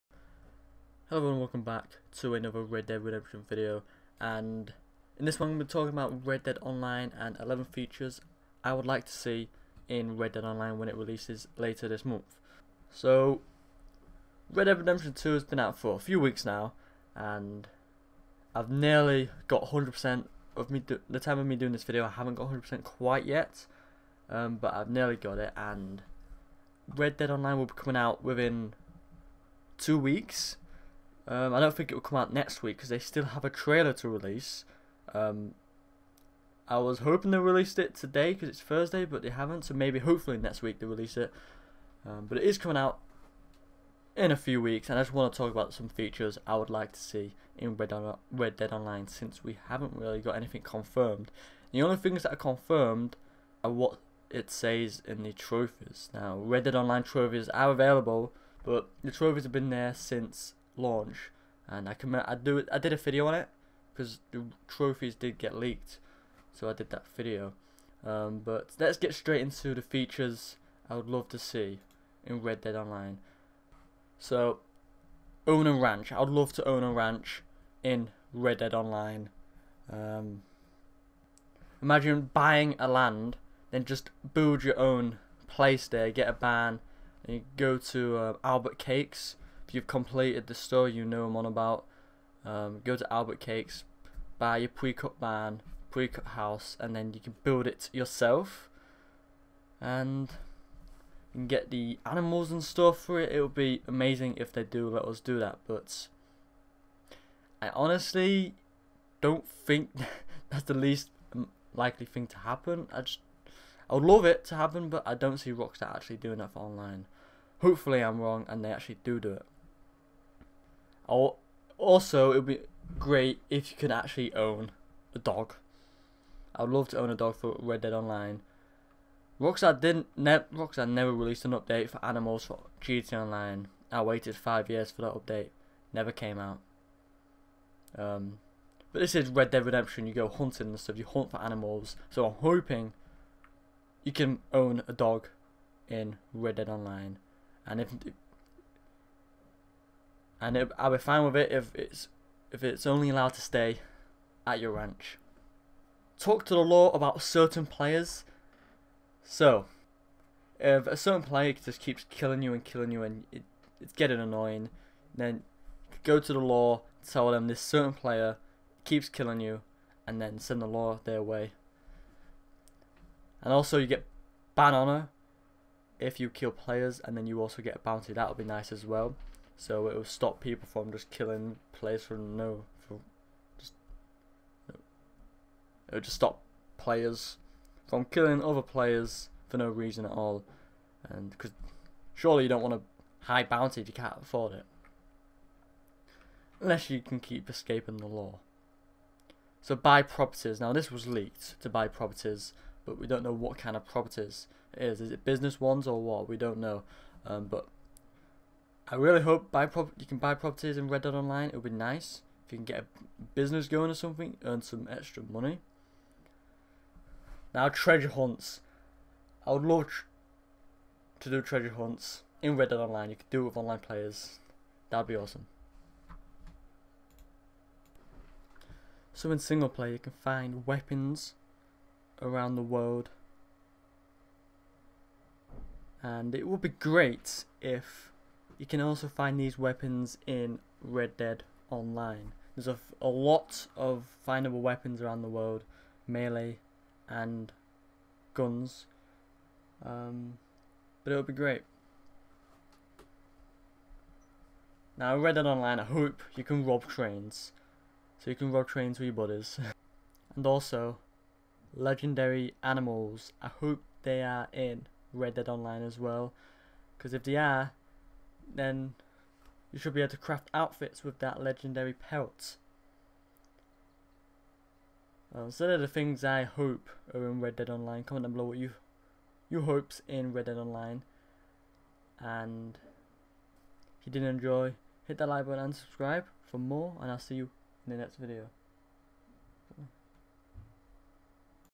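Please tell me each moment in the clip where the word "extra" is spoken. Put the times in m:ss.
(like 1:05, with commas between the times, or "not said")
3:34.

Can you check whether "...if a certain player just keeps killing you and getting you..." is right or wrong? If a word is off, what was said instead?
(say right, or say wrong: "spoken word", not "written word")
wrong: "killing", not "getting".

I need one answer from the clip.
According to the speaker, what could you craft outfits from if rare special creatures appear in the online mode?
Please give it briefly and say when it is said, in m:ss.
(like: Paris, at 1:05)
legendary pelt, at 4:31.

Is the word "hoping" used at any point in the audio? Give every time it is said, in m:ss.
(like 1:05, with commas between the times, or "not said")
0:36, 2:22.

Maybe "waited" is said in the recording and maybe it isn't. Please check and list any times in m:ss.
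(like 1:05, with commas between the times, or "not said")
2:14.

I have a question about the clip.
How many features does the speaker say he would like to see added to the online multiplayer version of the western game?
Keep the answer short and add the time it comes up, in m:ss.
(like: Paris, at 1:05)
11, at 0:07.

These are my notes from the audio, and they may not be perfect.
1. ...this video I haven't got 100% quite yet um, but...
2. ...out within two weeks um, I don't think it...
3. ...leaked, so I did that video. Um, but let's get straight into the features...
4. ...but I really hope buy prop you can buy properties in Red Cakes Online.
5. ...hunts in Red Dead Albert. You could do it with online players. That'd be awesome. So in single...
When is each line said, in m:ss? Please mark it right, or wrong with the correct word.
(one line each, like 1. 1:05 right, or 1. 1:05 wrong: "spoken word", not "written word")
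1. 0:21 right
2. 0:28 right
3. 1:05 right
4. 3:27 wrong: "Dead", not "Cakes"
5. 3:41 wrong: "Online", not "Albert".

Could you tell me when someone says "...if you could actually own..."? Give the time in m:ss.
2:03.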